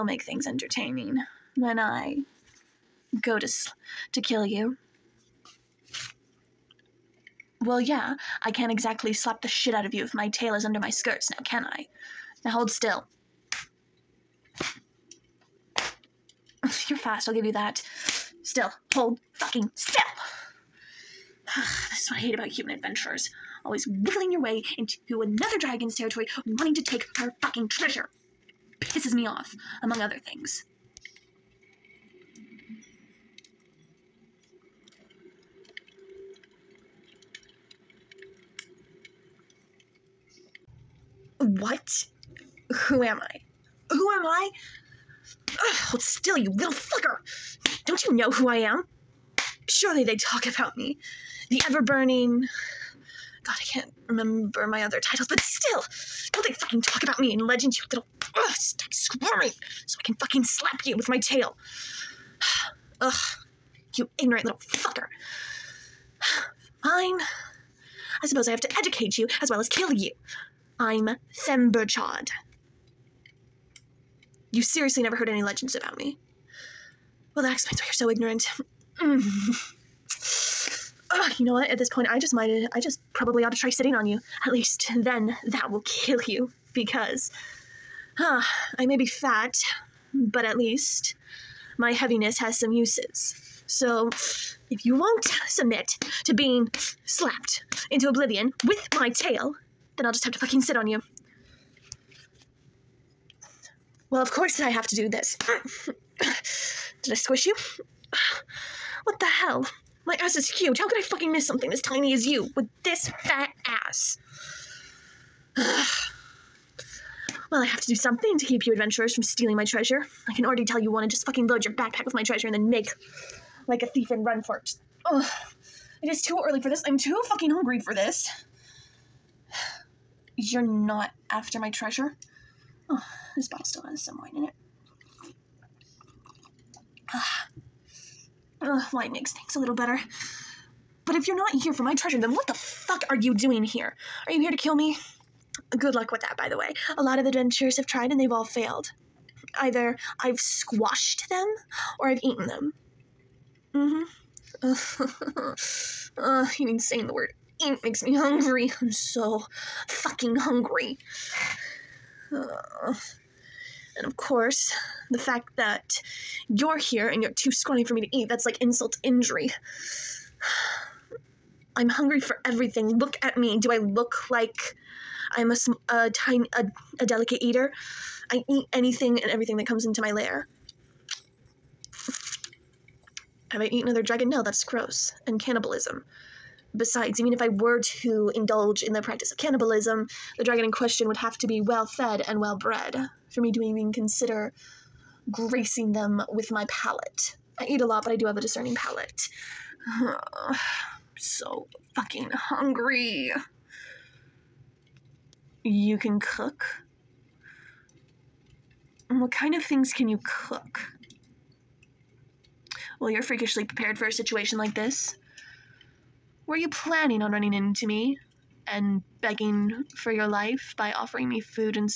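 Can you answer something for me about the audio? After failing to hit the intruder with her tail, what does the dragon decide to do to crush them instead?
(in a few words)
Sit on you.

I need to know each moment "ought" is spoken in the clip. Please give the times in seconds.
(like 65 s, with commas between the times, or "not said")
83 s.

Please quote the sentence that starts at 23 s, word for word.
Always wiggling your way into another dragon's territory, wanting to take her fucking treasure.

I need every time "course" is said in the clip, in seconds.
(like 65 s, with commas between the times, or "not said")
104 s, 164 s.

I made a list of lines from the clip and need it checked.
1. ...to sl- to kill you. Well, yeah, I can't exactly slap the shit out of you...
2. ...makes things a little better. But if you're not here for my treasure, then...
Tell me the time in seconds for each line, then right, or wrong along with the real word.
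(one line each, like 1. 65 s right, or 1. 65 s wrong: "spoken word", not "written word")
1. 3 s right
2. 139 s right.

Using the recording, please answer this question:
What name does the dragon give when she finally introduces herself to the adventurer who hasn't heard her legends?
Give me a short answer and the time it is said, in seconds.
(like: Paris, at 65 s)
Themberchaud, at 70 s.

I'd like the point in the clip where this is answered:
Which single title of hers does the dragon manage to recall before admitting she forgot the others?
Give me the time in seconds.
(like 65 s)
51 s.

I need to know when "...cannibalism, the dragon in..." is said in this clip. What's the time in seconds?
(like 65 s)
189 s.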